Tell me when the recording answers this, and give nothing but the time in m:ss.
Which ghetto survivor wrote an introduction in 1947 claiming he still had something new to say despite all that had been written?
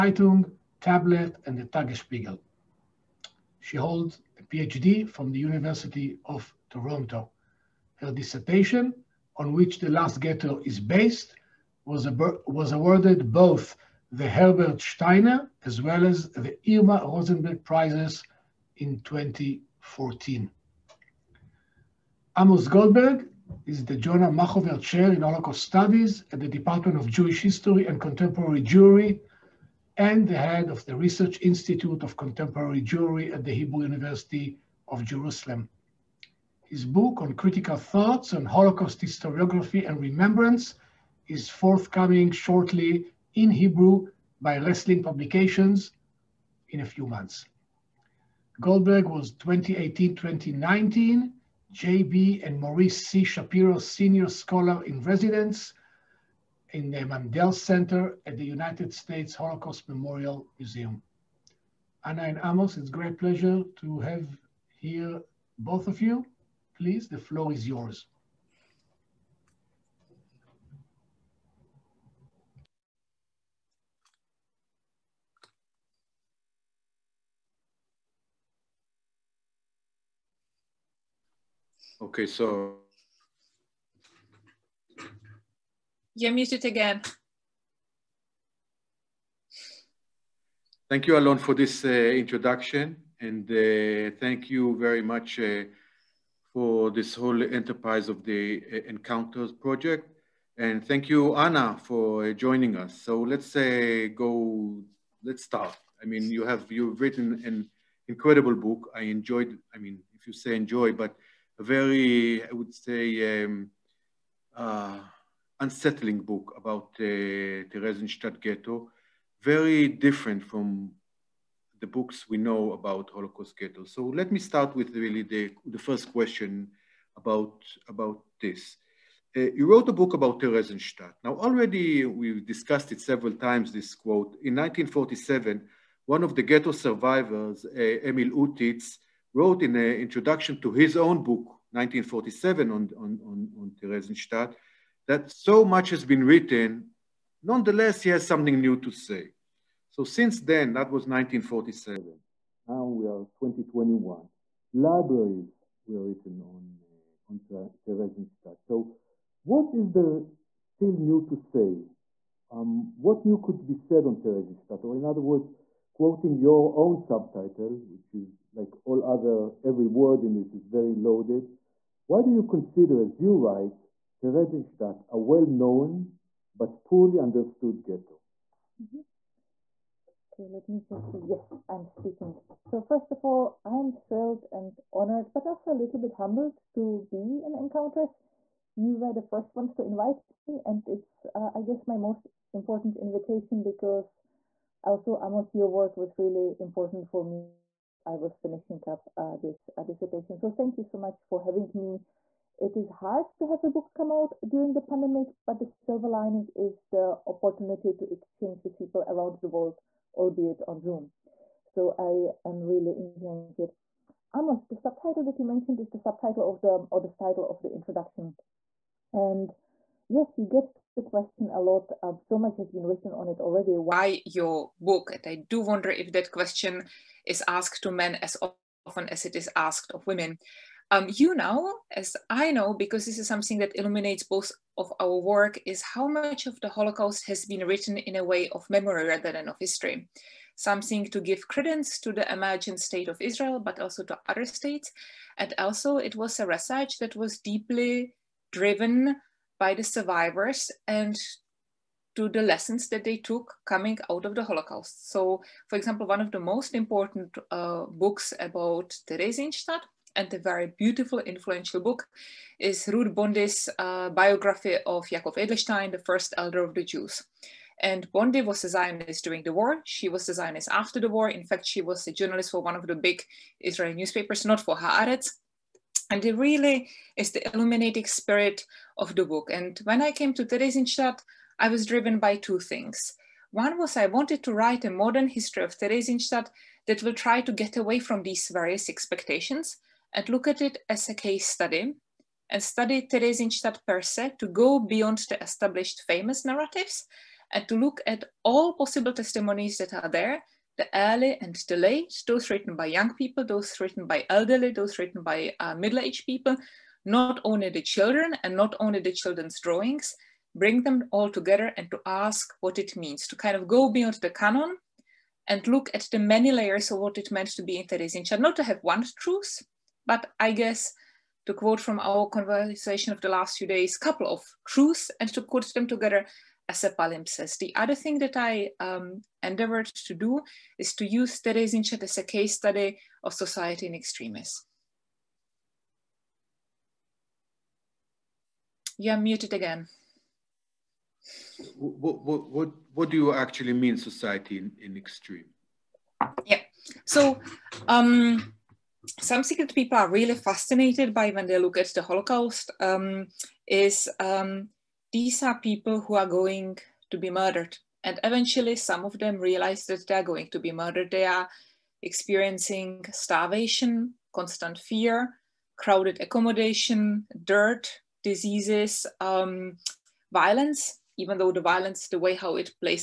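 2:18.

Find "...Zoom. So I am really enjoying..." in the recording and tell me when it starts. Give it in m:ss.
3:30.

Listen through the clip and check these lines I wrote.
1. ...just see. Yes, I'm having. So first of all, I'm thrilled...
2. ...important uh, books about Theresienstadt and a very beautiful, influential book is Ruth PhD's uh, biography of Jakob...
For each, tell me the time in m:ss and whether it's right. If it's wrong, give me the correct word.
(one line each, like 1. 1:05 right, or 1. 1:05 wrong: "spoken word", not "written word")
1. 3:00 wrong: "speaking", not "having"
2. 4:16 wrong: "Bondy", not "PhD".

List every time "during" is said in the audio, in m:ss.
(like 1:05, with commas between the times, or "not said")
3:24, 4:29.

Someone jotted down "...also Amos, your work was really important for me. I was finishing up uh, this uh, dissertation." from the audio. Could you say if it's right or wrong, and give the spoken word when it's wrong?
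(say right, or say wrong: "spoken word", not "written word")
right.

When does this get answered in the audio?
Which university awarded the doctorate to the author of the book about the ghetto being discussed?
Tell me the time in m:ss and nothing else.
0:05.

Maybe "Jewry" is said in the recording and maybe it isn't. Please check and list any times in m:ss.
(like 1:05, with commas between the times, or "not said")
0:28, 0:32.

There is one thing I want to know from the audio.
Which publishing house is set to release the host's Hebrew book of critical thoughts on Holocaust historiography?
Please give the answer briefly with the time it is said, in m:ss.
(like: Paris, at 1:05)
Resling Publications, at 0:44.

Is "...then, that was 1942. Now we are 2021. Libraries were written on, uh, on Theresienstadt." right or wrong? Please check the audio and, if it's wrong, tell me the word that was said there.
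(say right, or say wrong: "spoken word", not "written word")
wrong: "1947", not "1942".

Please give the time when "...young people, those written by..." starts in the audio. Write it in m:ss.
5:02.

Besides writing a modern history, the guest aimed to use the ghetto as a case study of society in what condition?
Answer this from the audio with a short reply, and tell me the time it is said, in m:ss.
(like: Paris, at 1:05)
in extremis, at 5:33.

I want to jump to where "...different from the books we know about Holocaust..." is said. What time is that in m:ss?
1:59.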